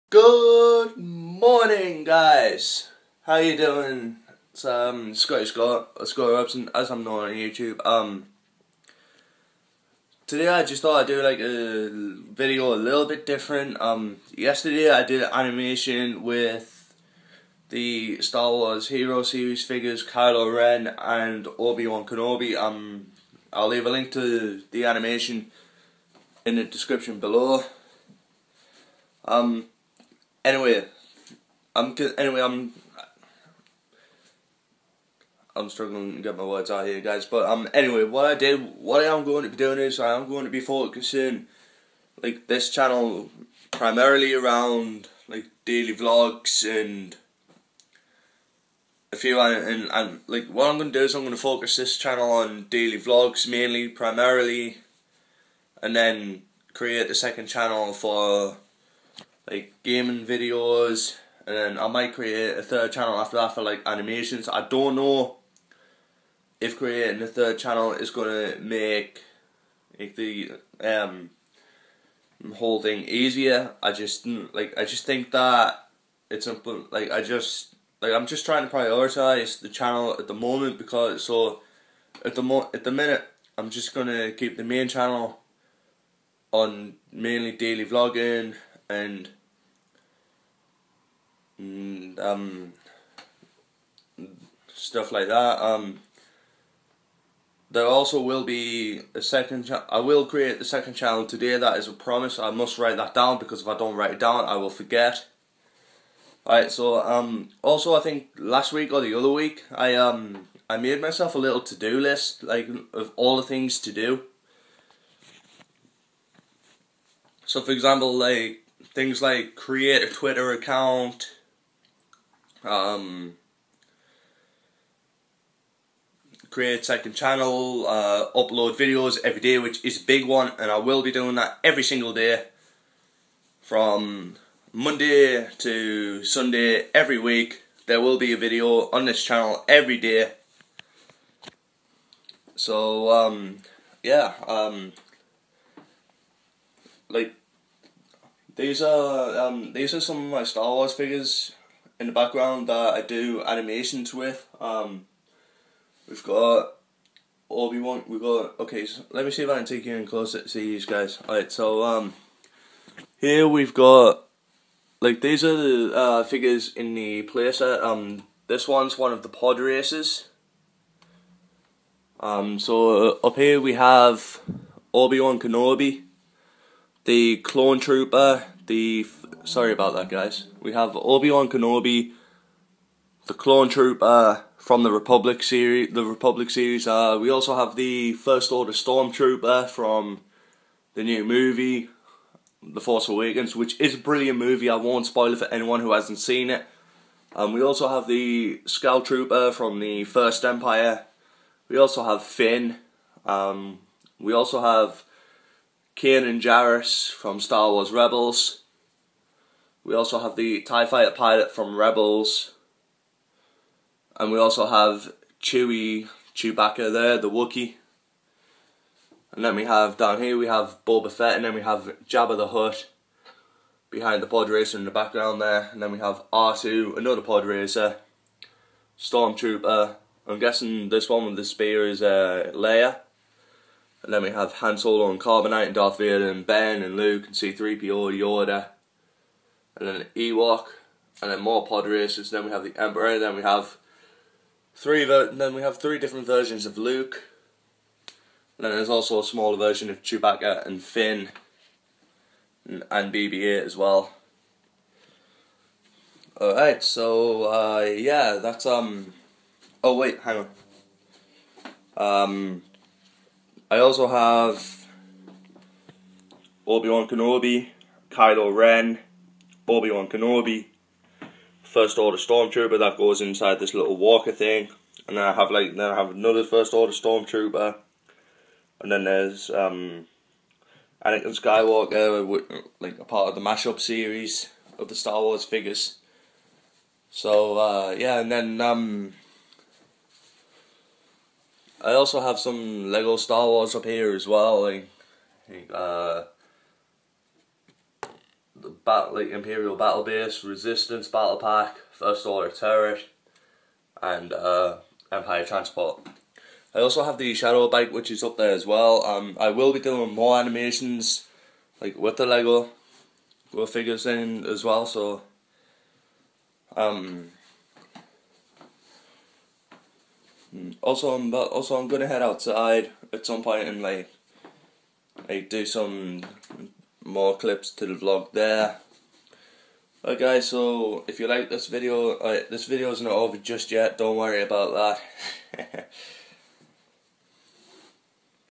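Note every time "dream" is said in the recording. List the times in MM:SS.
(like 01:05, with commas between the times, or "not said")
not said.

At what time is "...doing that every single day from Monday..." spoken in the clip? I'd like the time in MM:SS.
02:11.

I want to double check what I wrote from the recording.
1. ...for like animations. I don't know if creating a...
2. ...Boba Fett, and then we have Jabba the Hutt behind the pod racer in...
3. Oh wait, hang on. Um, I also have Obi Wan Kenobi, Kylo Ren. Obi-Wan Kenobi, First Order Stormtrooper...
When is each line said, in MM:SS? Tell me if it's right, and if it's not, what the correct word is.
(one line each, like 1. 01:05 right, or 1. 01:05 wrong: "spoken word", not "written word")
1. 01:03 right
2. 03:40 right
3. 04:19 right.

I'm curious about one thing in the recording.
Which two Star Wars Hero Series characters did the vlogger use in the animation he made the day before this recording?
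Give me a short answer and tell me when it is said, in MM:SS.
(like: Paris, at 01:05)
Kylo Ren and Obi Wan Kenobi, at 00:20.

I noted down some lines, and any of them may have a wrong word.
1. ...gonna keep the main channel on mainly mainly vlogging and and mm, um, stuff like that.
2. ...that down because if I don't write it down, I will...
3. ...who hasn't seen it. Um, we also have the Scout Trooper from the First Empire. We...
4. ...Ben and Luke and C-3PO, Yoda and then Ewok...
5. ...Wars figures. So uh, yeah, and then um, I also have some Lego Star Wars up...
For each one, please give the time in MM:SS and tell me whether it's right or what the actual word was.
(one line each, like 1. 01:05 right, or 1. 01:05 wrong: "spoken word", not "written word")
1. 01:23 wrong: "daily", not "mainly"
2. 01:42 right
3. 03:15 right
4. 03:56 right
5. 04:45 right.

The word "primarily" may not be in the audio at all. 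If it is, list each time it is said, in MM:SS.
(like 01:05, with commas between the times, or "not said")
00:43, 00:53.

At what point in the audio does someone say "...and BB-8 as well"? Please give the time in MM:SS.
04:12.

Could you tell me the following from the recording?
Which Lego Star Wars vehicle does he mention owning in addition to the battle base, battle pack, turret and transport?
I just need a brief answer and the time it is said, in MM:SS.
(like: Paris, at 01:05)
Shadow Bike, at 05:07.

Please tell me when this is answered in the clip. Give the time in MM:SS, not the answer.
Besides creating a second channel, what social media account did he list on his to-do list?
02:00.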